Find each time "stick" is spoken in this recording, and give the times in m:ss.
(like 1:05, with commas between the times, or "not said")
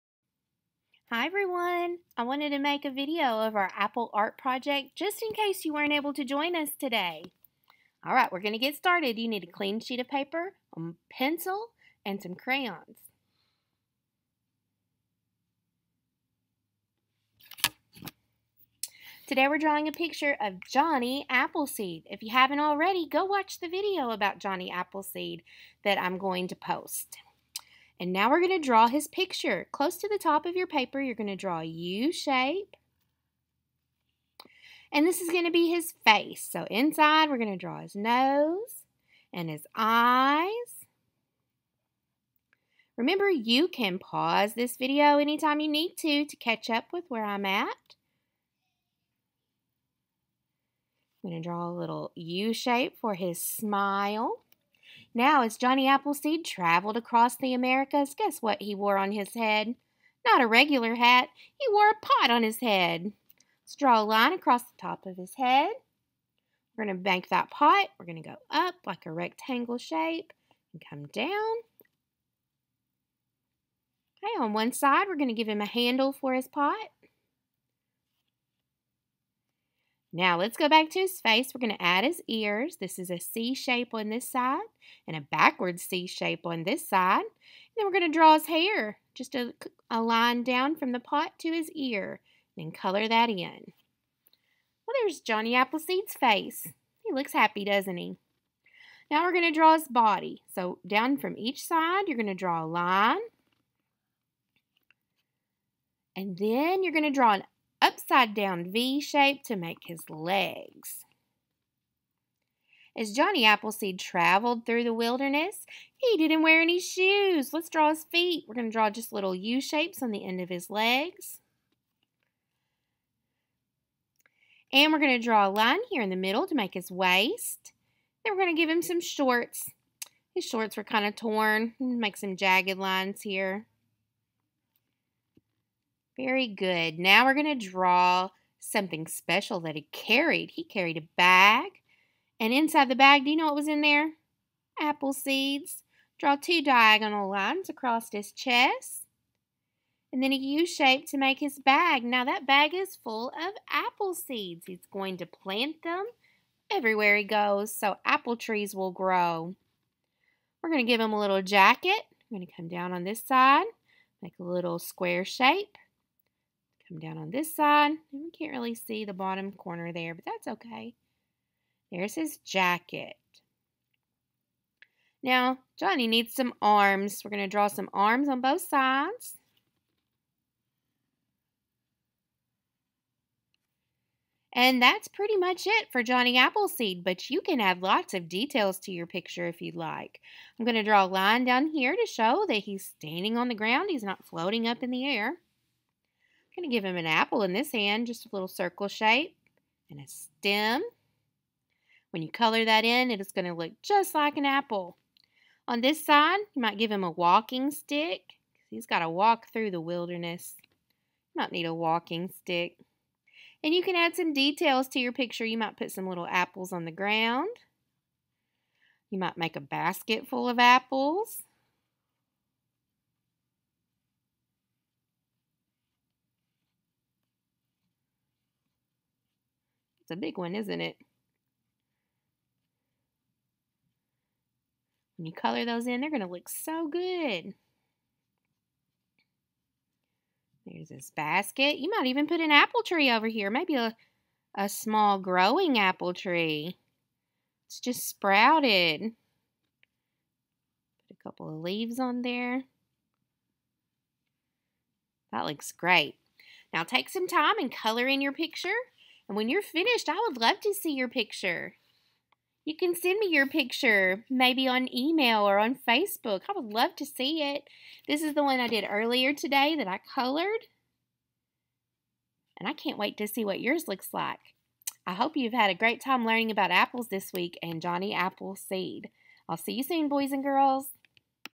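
3:27, 3:32.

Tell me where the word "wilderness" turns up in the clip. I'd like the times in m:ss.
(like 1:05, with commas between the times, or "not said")
1:54, 3:29.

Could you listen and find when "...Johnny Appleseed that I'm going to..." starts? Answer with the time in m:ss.
0:24.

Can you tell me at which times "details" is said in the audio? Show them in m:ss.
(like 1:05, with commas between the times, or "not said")
3:08, 3:34.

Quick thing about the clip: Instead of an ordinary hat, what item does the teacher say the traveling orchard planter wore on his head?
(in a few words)
A pot.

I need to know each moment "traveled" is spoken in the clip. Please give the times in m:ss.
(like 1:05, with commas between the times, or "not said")
0:56, 1:53.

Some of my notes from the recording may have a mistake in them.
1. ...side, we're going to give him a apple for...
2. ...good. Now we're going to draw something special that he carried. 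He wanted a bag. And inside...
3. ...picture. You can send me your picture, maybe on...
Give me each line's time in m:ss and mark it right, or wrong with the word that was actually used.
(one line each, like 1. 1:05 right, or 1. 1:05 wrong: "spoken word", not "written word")
1. 1:14 wrong: "handle", not "apple"
2. 2:16 wrong: "carried", not "wanted"
3. 4:21 right.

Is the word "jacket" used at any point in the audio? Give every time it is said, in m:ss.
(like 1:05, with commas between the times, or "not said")
2:41, 2:52.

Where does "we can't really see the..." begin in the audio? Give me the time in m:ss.
2:48.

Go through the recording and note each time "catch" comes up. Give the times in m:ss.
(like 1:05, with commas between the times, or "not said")
0:46.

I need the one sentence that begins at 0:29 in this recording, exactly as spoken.
Close to the top of your paper, you're going to draw a U-shape.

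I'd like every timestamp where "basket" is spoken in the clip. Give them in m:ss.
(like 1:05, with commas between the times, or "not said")
3:39, 4:01.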